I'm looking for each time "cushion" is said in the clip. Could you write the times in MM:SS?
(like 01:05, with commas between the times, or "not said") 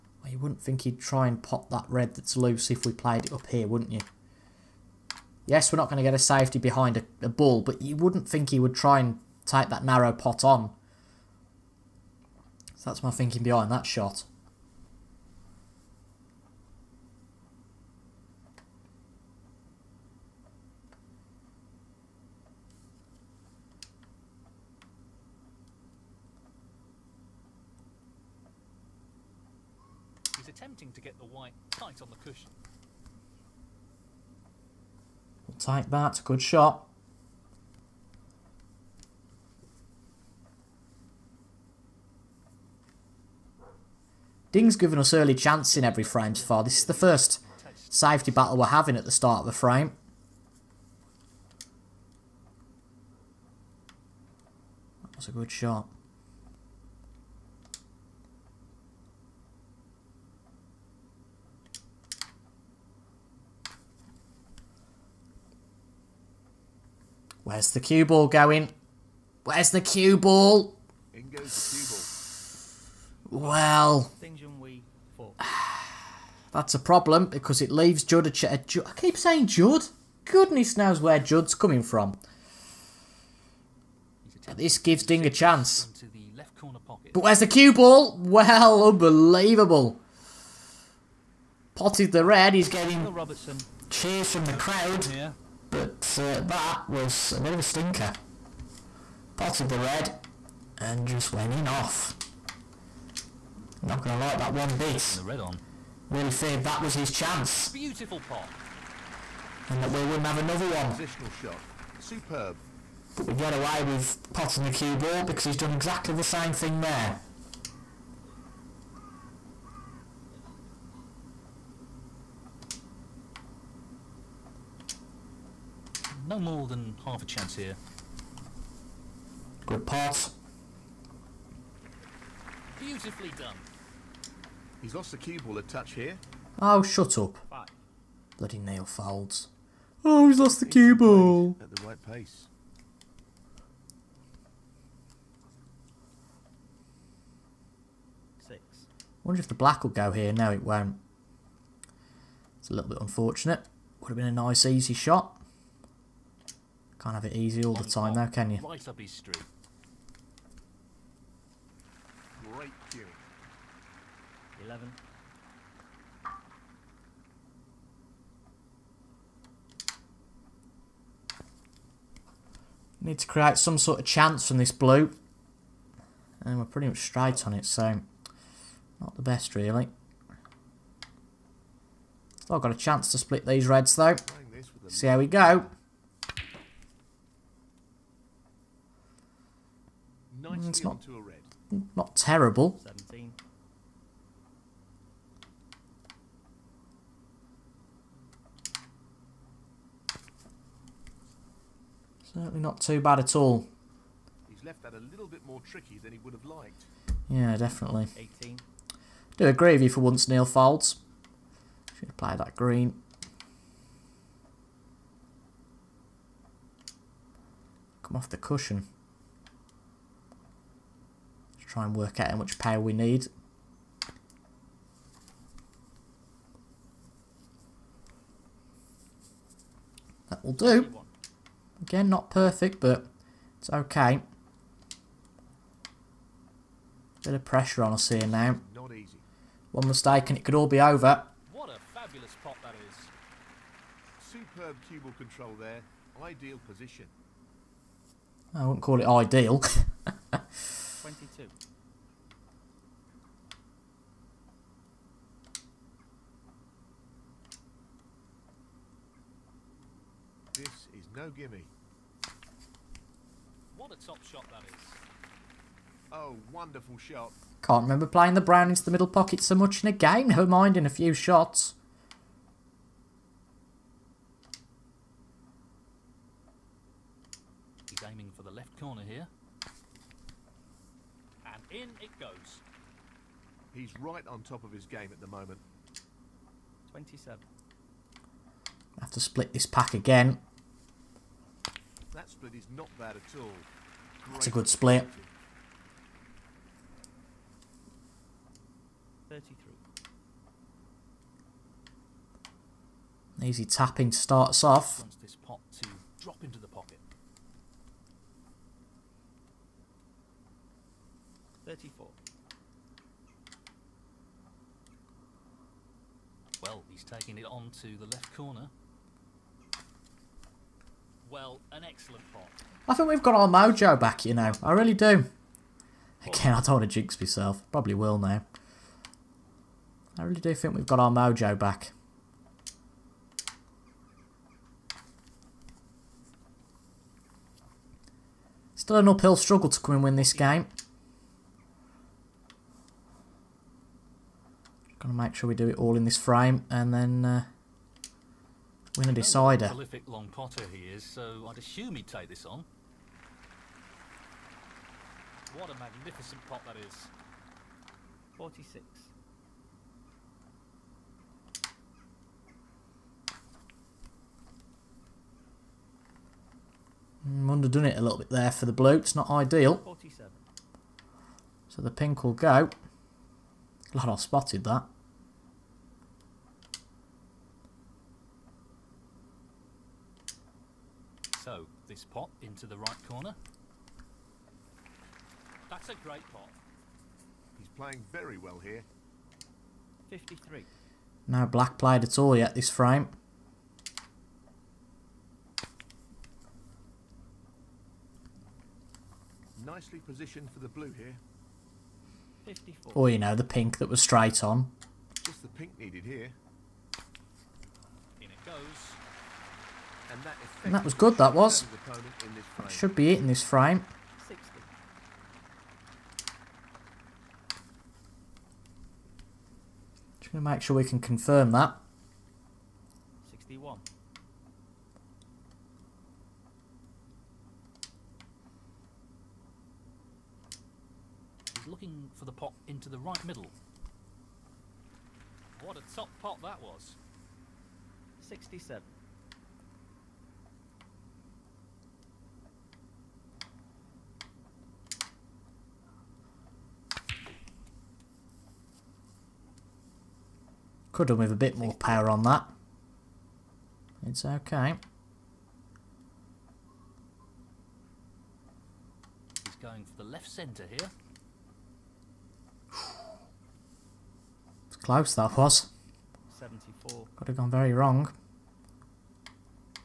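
00:32, 03:38.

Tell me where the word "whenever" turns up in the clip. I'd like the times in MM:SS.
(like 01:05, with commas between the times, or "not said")
not said.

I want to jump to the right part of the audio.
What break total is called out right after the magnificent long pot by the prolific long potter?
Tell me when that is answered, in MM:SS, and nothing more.
05:58.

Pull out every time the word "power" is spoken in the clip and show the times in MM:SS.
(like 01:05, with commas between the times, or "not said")
03:42, 07:31.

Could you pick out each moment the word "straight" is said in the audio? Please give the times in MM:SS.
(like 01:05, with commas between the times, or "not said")
02:56, 06:44.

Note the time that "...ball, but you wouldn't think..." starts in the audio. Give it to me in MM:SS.
00:07.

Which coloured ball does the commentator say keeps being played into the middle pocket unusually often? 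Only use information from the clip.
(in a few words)
Brown.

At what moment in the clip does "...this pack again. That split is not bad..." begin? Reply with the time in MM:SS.
04:49.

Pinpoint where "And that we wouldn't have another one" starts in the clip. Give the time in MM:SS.
01:49.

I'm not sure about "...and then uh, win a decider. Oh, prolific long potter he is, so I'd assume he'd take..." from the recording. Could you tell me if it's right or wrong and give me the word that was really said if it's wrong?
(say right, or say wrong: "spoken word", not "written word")
right.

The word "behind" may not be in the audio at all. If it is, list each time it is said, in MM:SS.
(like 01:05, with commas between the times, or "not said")
00:06, 00:13.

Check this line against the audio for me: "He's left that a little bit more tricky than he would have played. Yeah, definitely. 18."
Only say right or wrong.
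wrong.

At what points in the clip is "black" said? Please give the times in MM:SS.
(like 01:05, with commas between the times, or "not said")
02:29, 06:31.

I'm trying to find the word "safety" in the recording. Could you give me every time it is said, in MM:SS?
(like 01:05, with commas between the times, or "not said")
00:06, 00:47.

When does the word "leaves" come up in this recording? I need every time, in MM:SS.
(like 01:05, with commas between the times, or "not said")
01:17.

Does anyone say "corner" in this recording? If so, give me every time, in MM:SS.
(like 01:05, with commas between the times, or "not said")
04:38, 05:18, 06:23.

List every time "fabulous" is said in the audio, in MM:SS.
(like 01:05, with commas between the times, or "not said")
04:01.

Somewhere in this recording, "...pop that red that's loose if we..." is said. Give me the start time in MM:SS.
00:01.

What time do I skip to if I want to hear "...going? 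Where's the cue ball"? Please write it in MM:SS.
01:08.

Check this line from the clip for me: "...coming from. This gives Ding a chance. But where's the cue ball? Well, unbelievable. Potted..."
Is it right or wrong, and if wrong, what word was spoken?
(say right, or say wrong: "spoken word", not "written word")
right.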